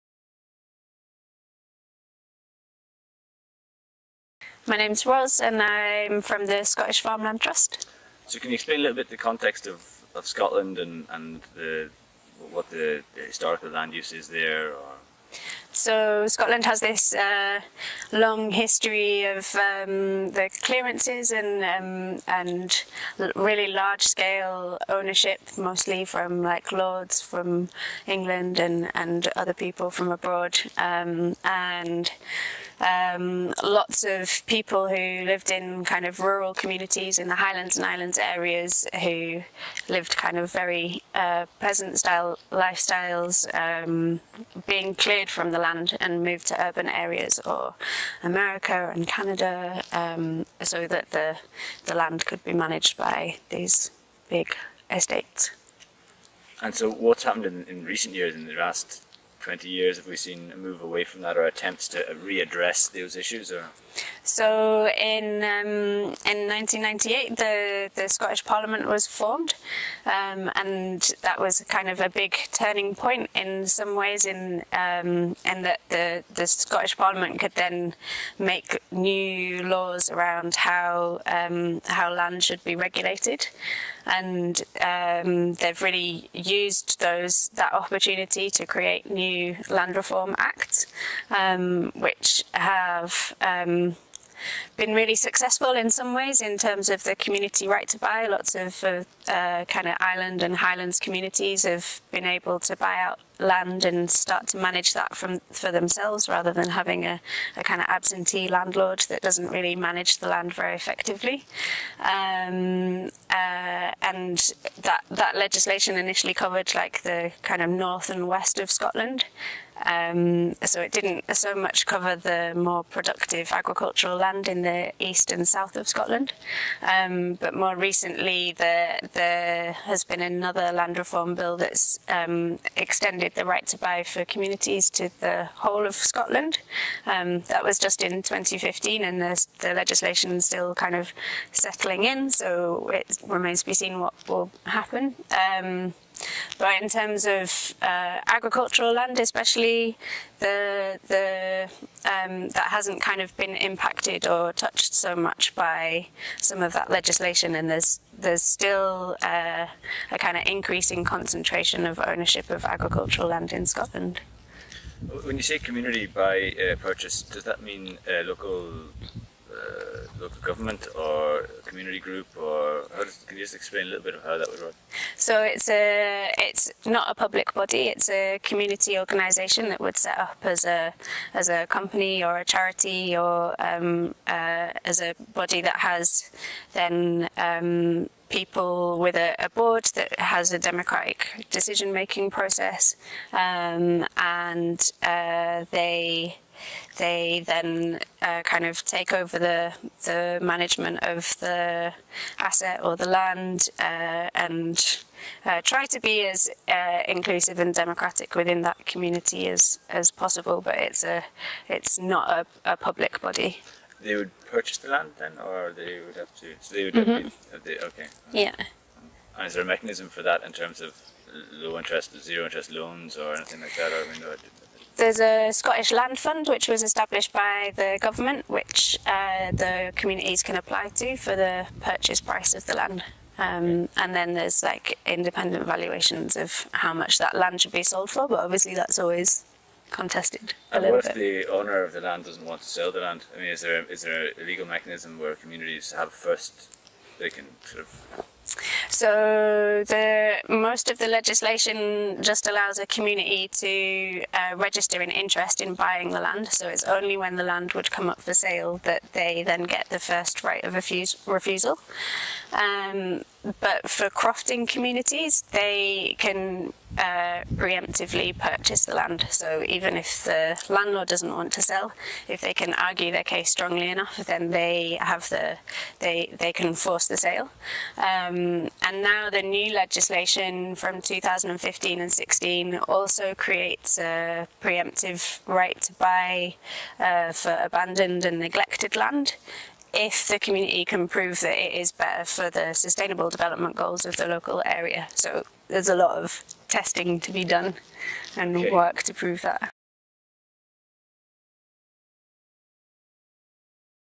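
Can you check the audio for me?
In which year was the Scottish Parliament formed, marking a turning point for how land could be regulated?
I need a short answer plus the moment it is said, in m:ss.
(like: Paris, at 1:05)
1998, at 1:06.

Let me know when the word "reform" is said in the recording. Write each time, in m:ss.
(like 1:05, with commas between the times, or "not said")
1:29, 2:10.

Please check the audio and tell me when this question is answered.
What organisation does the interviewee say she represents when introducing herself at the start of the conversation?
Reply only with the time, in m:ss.
0:06.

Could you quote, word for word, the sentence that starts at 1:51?
Um, uh, and that that legislation initially covered like the kind of north and west of Scotland.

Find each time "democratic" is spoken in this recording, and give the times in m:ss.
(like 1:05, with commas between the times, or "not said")
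3:10, 3:27.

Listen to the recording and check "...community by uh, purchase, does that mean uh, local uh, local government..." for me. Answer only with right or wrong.
right.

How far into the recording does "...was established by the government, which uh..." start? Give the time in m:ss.
3:46.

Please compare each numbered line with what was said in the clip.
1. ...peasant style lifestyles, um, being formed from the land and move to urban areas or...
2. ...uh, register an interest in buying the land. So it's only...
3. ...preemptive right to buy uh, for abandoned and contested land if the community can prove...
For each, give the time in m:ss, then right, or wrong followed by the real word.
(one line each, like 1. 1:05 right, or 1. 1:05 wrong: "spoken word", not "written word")
1. 0:41 wrong: "cleared", not "formed"
2. 4:14 right
3. 4:44 wrong: "neglected", not "contested".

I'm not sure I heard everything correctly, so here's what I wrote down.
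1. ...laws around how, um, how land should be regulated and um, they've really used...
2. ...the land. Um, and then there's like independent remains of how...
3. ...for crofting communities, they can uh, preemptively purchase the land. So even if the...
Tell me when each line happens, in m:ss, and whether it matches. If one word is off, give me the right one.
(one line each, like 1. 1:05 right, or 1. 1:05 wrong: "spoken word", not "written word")
1. 1:19 right
2. 3:52 wrong: "valuations", not "remains"
3. 4:23 right.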